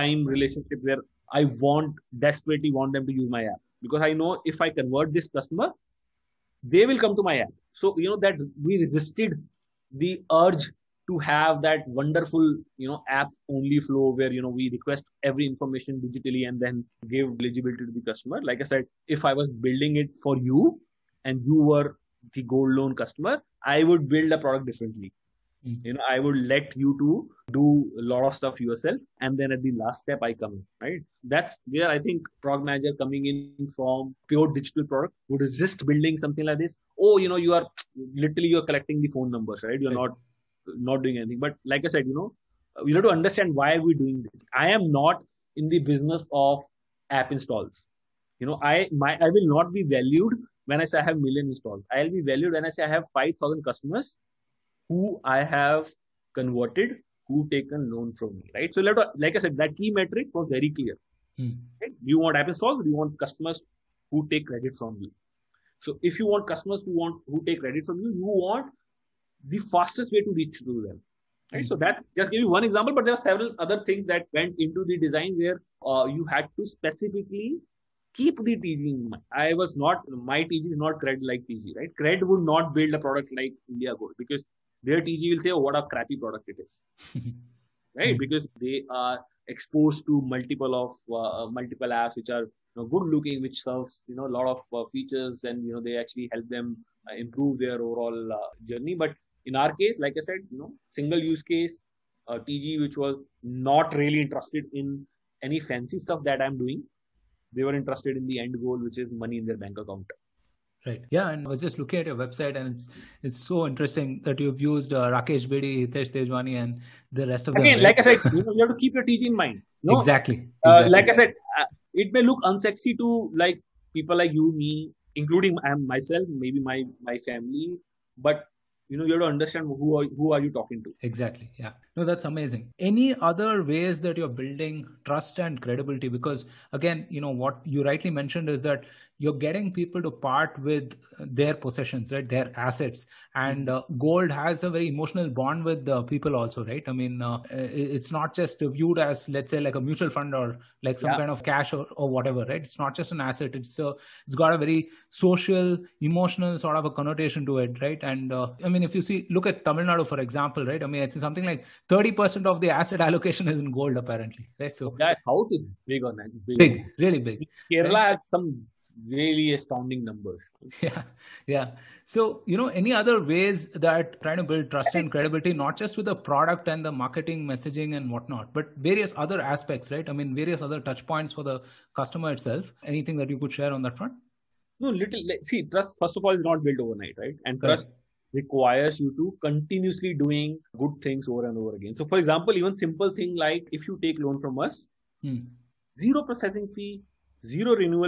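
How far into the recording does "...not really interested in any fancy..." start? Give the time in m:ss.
1:43.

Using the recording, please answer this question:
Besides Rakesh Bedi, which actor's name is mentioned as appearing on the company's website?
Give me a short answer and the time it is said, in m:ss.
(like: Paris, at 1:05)
Hitesh Tejwani, at 1:55.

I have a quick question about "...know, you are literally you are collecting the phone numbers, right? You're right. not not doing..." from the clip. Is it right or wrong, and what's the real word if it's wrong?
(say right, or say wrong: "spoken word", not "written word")
right.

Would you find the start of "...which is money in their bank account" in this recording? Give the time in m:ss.
1:48.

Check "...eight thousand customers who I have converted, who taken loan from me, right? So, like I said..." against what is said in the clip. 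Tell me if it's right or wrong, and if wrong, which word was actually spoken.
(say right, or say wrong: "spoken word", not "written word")
wrong: "five", not "eight".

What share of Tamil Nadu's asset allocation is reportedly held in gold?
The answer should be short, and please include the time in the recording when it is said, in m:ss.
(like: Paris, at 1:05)
30%, at 2:41.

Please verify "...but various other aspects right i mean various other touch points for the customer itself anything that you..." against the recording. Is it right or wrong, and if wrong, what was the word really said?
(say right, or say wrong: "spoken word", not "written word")
right.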